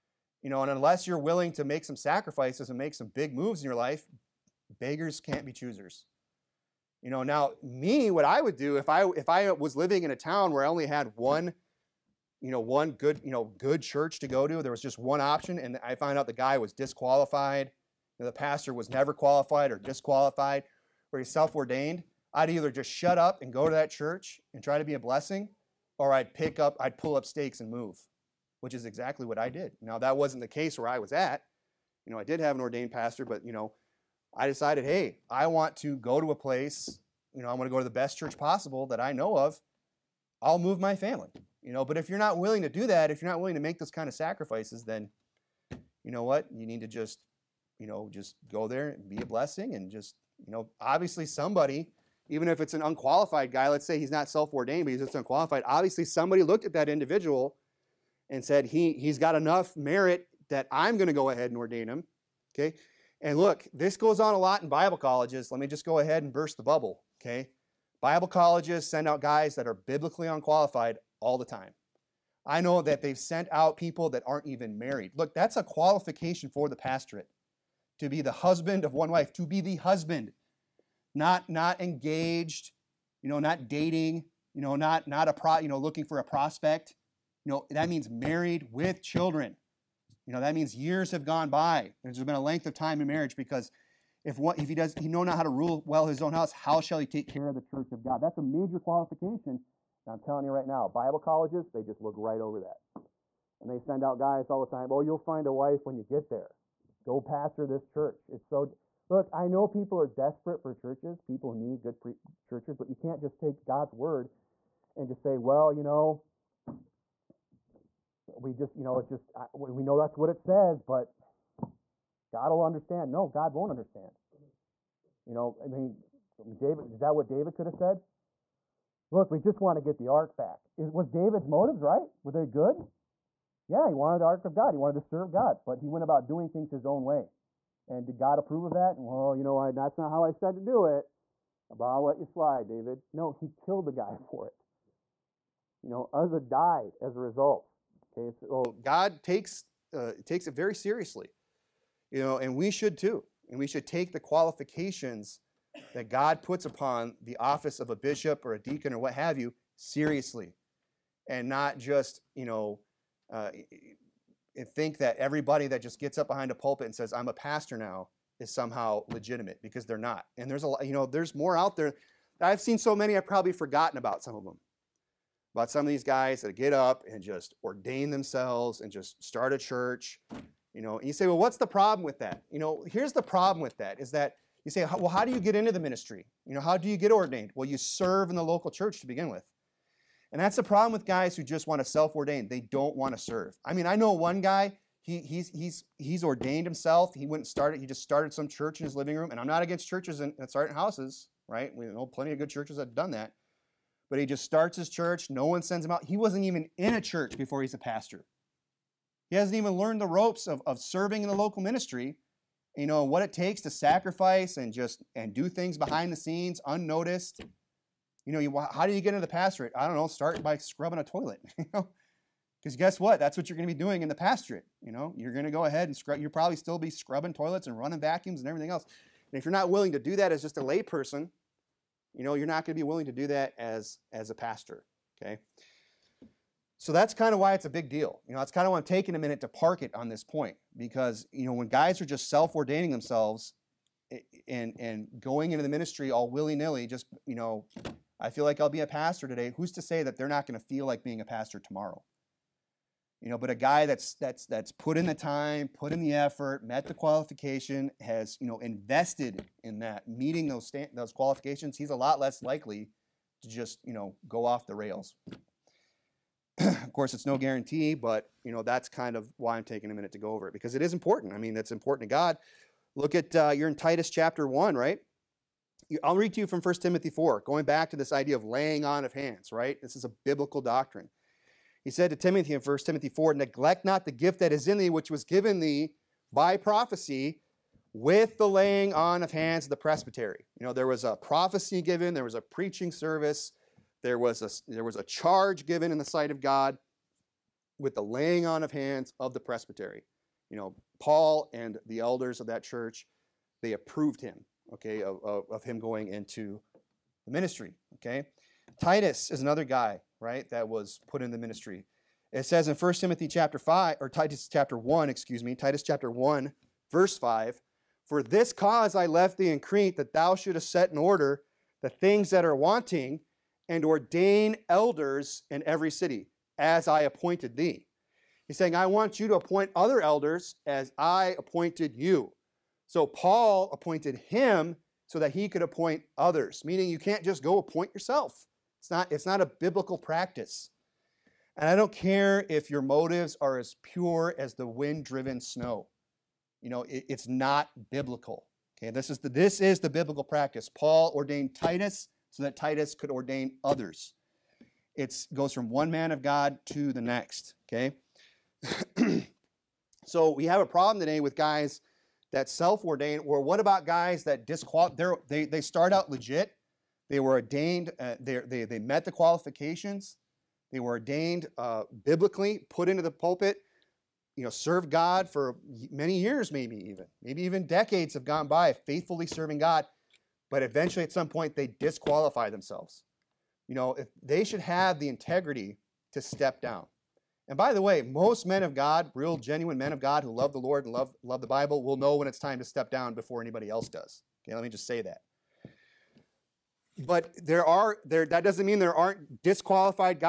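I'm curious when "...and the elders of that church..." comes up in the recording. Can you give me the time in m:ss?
5:01.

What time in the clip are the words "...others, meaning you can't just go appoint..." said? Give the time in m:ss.
5:36.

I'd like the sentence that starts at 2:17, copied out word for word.
And did God approve of that?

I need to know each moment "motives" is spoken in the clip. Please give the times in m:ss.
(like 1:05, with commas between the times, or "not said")
2:11, 5:42.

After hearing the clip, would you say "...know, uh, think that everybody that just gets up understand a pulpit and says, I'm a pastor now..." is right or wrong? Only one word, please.
wrong.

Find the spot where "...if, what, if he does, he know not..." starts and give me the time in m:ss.
1:34.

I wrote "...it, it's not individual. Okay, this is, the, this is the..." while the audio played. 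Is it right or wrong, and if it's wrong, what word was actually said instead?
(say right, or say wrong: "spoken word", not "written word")
wrong: "biblical", not "individual".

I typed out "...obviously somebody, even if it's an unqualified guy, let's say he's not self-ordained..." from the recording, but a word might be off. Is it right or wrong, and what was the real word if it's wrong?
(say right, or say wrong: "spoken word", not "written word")
right.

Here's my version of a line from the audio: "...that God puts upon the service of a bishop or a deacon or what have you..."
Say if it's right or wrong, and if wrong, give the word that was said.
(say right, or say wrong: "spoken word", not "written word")
wrong: "office", not "service".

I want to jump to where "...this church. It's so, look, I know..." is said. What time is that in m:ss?
1:47.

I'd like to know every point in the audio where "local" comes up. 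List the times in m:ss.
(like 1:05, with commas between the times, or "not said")
3:08, 3:31.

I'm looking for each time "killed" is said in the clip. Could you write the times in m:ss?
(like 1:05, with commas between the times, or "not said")
2:23.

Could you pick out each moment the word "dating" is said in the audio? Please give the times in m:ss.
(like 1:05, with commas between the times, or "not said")
1:23.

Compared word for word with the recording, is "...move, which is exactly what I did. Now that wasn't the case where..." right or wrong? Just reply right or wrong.
right.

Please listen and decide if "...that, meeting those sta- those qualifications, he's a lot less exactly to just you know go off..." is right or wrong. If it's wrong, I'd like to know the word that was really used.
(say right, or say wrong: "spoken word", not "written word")
wrong: "likely", not "exactly".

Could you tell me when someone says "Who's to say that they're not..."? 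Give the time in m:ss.
4:09.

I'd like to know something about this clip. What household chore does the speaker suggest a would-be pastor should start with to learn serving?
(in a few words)
scrubbing a toilet.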